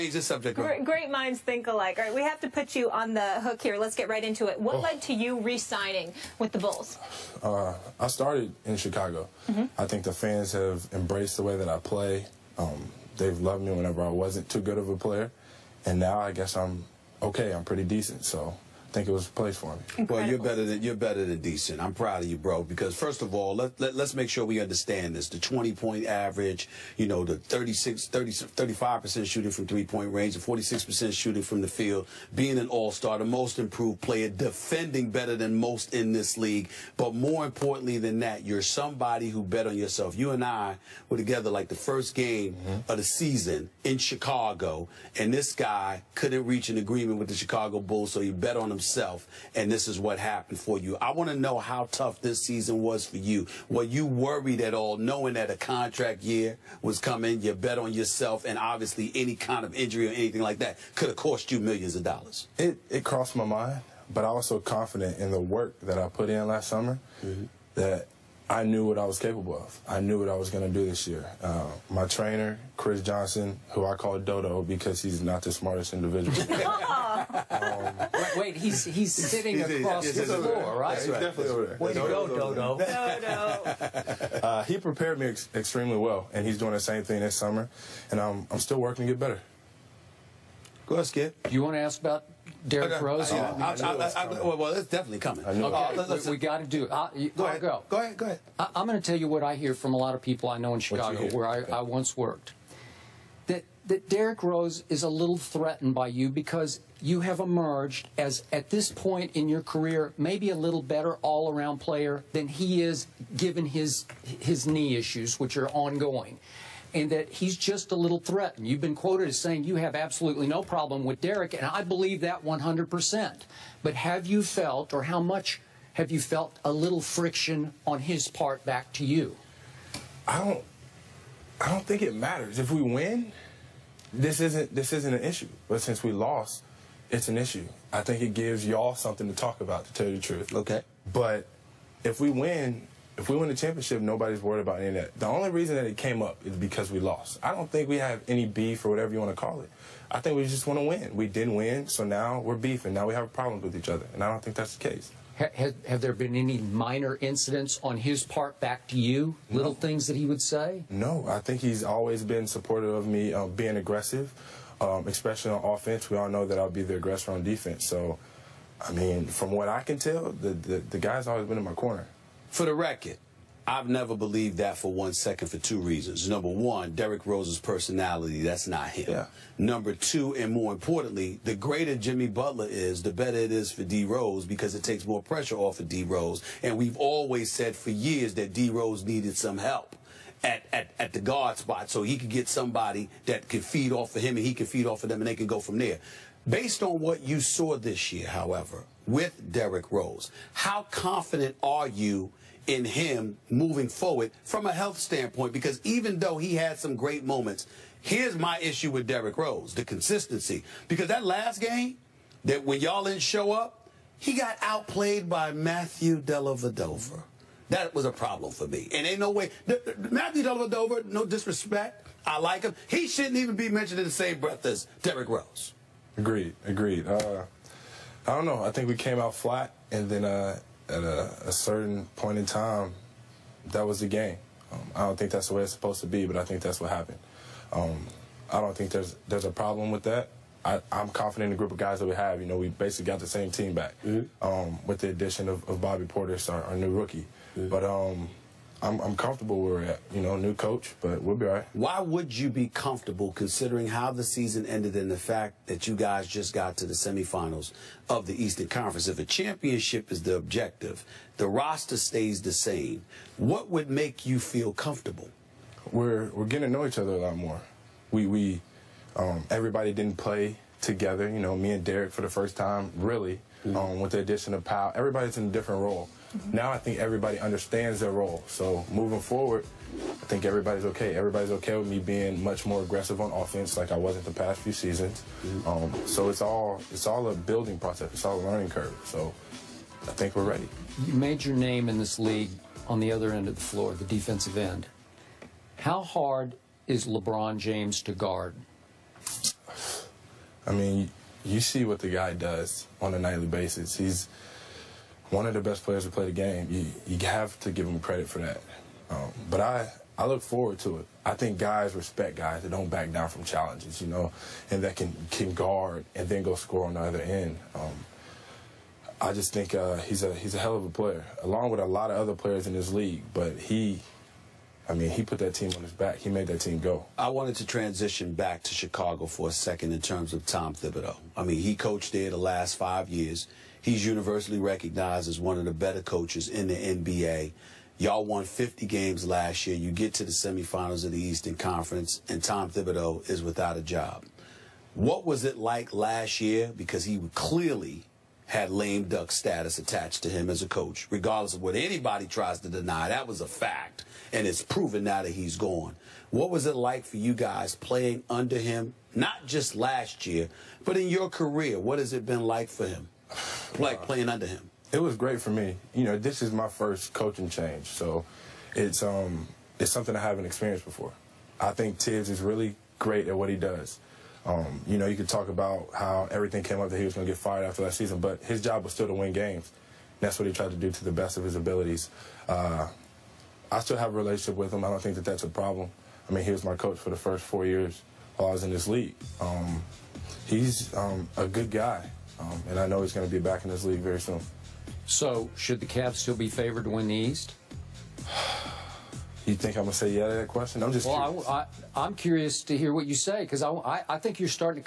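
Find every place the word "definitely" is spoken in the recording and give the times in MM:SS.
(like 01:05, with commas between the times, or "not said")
01:21, 01:34.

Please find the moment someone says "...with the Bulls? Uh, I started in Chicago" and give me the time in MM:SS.
00:06.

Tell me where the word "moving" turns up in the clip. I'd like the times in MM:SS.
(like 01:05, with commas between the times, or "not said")
03:23, 04:38.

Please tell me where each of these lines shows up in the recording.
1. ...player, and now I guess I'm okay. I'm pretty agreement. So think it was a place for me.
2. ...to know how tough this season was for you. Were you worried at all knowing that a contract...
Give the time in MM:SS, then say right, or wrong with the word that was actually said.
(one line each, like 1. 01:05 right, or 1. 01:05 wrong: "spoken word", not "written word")
1. 00:15 wrong: "decent", not "agreement"
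2. 00:51 right.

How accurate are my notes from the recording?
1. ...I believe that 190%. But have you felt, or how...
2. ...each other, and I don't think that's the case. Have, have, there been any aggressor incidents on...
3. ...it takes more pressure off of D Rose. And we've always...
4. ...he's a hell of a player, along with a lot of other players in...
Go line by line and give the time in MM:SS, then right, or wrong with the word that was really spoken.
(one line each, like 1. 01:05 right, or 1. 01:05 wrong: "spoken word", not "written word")
1. 02:01 wrong: "100", not "190"
2. 02:33 wrong: "minor", not "aggressor"
3. 03:04 right
4. 05:20 right.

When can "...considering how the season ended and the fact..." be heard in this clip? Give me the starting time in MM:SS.
04:13.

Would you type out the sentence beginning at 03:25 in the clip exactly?
Because even though he had some great moments, here's my issue with Derrick Rose, the consistency.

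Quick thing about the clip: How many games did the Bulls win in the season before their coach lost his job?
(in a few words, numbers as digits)
50.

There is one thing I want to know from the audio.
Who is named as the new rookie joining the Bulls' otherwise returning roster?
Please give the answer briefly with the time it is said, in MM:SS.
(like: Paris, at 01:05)
Bobby Portis, at 04:05.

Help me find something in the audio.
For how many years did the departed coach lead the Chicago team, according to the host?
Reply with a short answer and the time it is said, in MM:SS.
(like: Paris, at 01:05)
5 years, at 05:32.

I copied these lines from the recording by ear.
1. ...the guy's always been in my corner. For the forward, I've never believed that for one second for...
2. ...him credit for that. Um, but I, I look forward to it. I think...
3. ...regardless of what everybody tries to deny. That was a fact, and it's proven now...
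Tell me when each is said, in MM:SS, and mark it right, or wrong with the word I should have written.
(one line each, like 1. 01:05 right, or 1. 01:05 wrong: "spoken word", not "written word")
1. 02:50 wrong: "record", not "forward"
2. 05:07 right
3. 05:51 wrong: "anybody", not "everybody".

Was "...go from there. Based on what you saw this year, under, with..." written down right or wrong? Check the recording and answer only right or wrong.
wrong.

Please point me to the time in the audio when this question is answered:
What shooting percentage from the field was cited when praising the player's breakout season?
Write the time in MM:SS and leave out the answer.
00:30.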